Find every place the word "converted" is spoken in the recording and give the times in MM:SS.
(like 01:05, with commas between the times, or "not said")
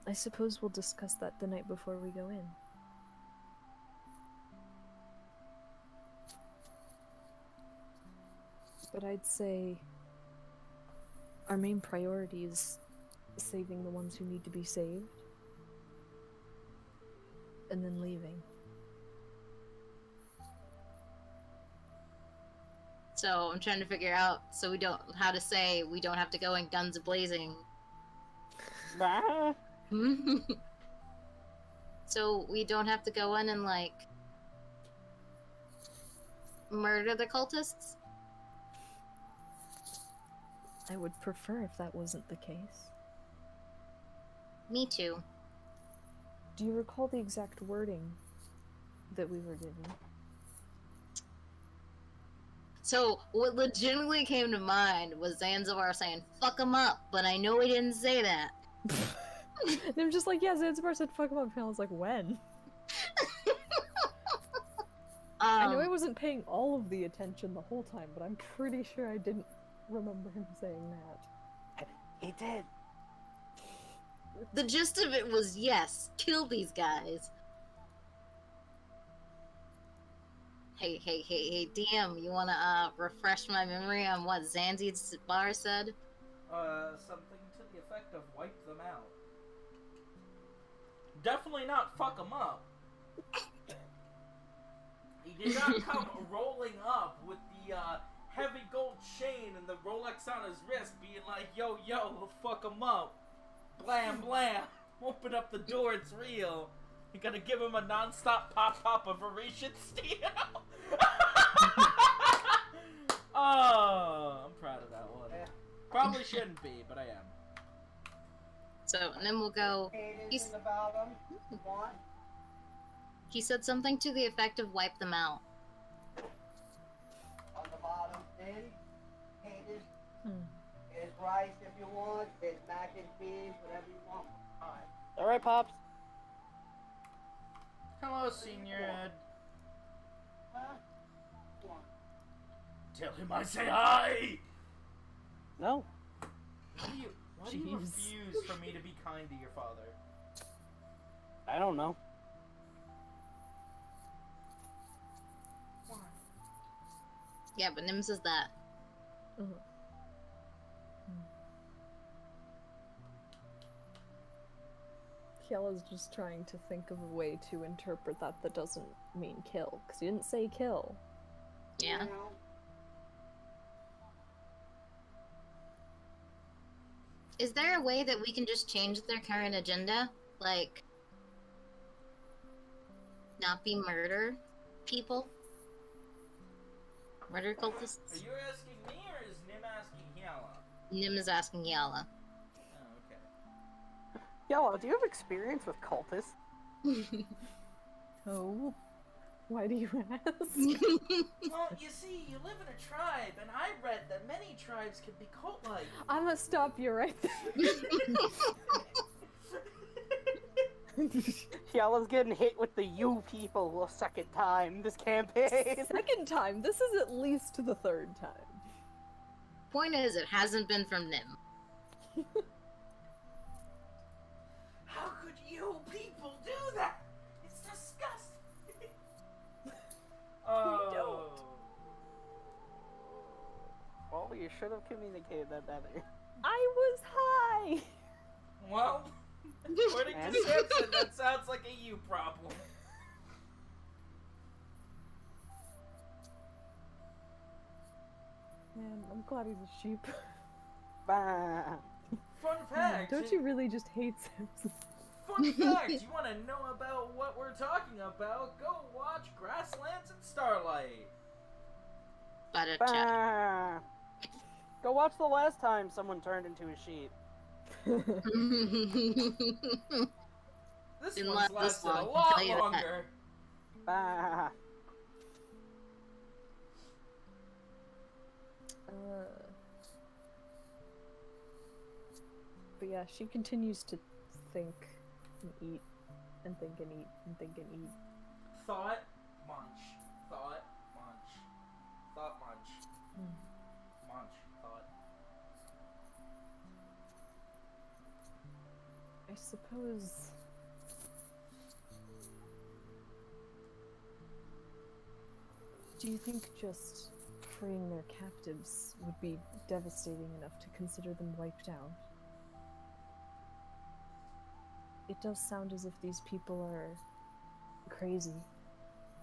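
not said.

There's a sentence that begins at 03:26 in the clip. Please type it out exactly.
I'm gonna stop you right there.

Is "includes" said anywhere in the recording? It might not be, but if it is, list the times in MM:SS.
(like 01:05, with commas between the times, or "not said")
not said.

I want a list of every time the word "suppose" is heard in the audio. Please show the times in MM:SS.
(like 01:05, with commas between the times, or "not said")
00:00, 04:59.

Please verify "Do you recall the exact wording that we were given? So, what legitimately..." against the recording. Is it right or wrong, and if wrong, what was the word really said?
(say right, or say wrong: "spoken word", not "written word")
right.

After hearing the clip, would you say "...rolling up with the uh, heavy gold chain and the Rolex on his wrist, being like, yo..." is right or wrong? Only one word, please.
right.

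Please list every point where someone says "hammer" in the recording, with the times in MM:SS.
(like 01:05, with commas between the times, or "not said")
not said.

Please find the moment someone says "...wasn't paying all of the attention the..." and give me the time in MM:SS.
01:05.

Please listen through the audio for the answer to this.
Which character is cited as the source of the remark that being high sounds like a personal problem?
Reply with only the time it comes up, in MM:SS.
04:00.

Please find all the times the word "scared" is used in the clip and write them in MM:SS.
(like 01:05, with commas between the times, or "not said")
not said.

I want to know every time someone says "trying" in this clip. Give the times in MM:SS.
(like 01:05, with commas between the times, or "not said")
00:23, 02:46.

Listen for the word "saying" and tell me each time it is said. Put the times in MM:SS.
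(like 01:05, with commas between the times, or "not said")
00:55, 01:10.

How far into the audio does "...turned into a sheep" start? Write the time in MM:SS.
04:26.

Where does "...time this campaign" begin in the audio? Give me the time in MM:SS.
03:34.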